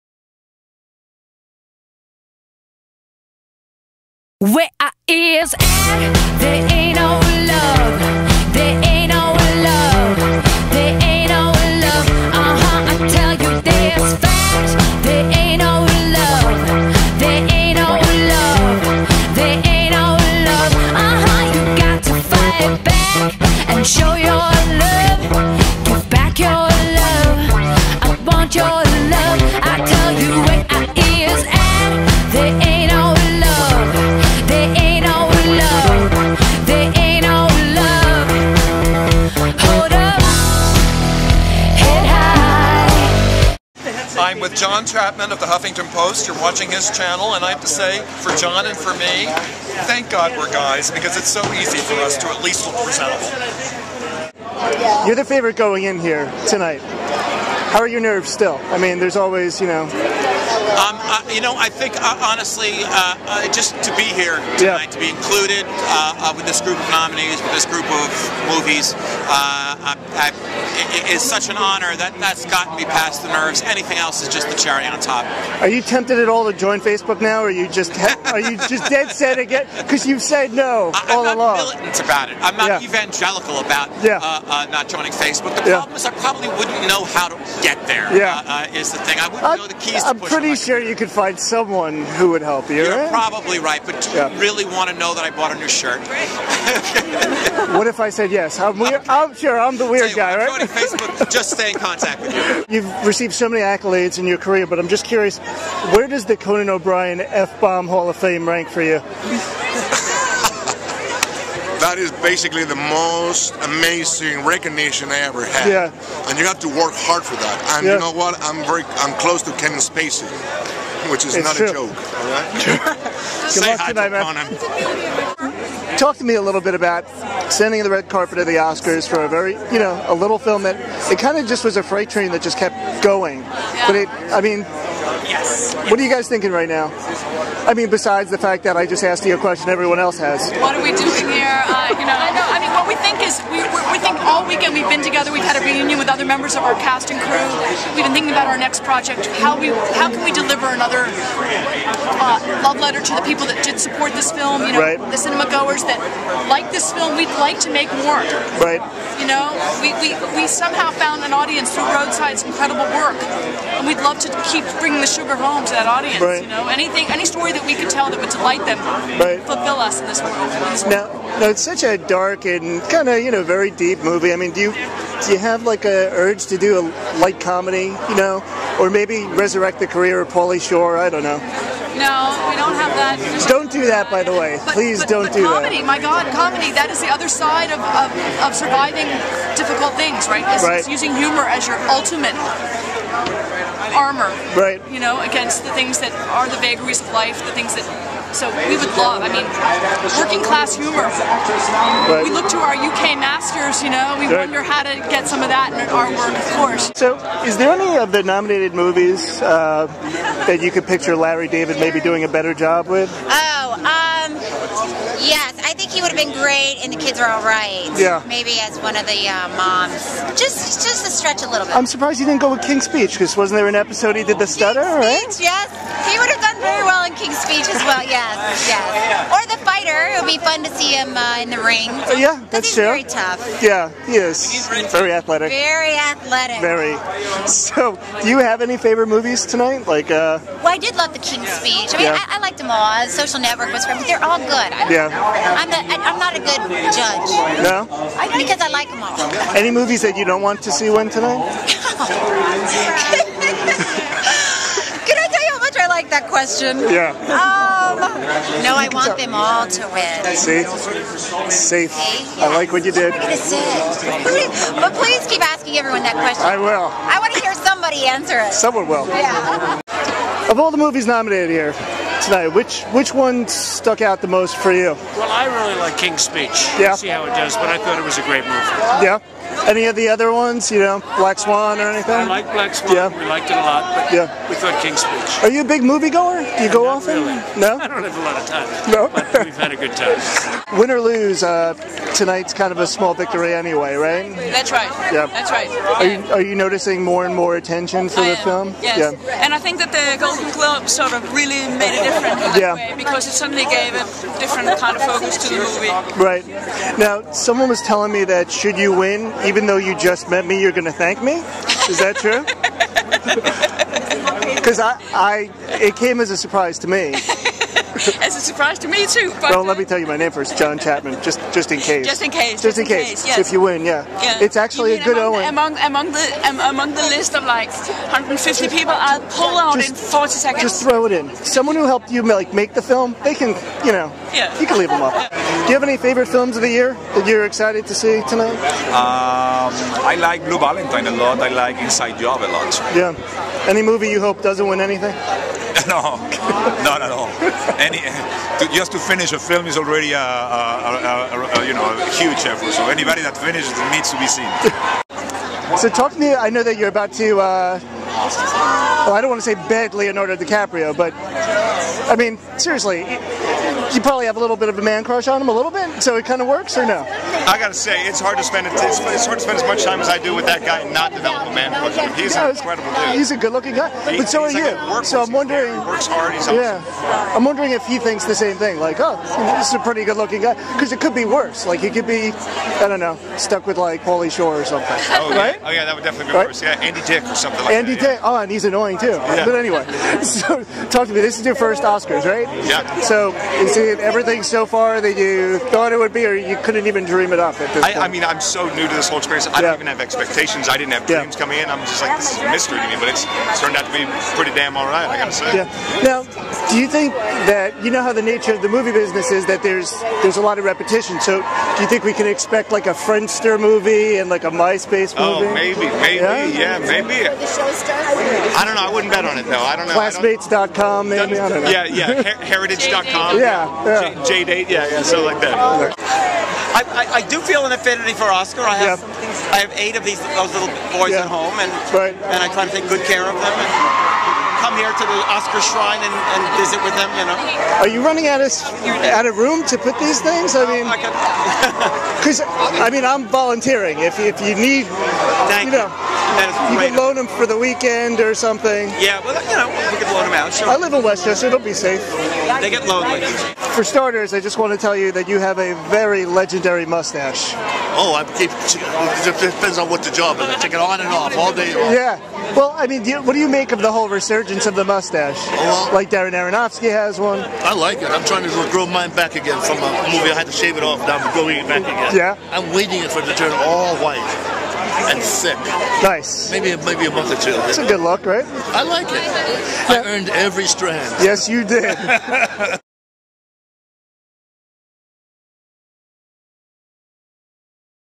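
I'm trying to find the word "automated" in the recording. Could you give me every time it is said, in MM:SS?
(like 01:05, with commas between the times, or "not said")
not said.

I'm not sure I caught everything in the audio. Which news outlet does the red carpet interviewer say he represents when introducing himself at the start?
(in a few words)
Huffington Post.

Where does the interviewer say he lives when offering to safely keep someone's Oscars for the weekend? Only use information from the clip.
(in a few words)
Westchester.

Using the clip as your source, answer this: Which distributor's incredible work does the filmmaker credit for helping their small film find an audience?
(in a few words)
Roadside.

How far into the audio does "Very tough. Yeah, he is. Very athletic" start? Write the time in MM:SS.
03:52.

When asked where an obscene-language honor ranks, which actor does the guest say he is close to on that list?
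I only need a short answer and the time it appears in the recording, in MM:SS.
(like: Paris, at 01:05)
Kevin Spacey, at 01:59.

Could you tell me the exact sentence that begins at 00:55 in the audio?
You're the favorite going in here tonight.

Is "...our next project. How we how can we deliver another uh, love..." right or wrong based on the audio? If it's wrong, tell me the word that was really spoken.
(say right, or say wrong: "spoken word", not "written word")
right.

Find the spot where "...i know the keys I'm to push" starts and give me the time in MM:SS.
01:29.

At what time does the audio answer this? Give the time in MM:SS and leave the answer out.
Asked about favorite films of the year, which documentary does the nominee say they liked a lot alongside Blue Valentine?
05:41.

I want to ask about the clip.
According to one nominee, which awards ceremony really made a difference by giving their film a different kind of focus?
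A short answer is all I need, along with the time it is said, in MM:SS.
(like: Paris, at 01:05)
Golden Globe, at 05:00.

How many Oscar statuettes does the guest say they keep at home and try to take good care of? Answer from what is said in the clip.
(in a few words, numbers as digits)
8.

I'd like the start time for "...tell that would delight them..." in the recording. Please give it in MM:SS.
02:47.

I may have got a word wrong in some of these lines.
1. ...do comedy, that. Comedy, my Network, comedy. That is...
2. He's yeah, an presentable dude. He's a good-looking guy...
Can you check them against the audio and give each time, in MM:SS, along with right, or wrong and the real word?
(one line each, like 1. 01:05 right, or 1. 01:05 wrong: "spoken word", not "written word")
1. 03:05 wrong: "God", not "Network"
2. 06:12 wrong: "incredible", not "presentable".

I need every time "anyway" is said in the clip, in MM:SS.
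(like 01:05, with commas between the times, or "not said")
04:53, 06:29.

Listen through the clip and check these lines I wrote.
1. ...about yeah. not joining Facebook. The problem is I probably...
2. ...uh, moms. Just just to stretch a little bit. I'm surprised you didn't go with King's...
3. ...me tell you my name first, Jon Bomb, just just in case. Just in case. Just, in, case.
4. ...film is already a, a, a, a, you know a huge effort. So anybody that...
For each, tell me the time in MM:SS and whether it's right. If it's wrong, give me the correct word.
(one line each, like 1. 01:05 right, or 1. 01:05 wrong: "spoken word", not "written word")
1. 01:23 right
2. 03:39 right
3. 05:19 wrong: "Chattman", not "Bomb"
4. 05:49 right.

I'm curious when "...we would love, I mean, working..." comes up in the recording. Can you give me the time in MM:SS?
03:18.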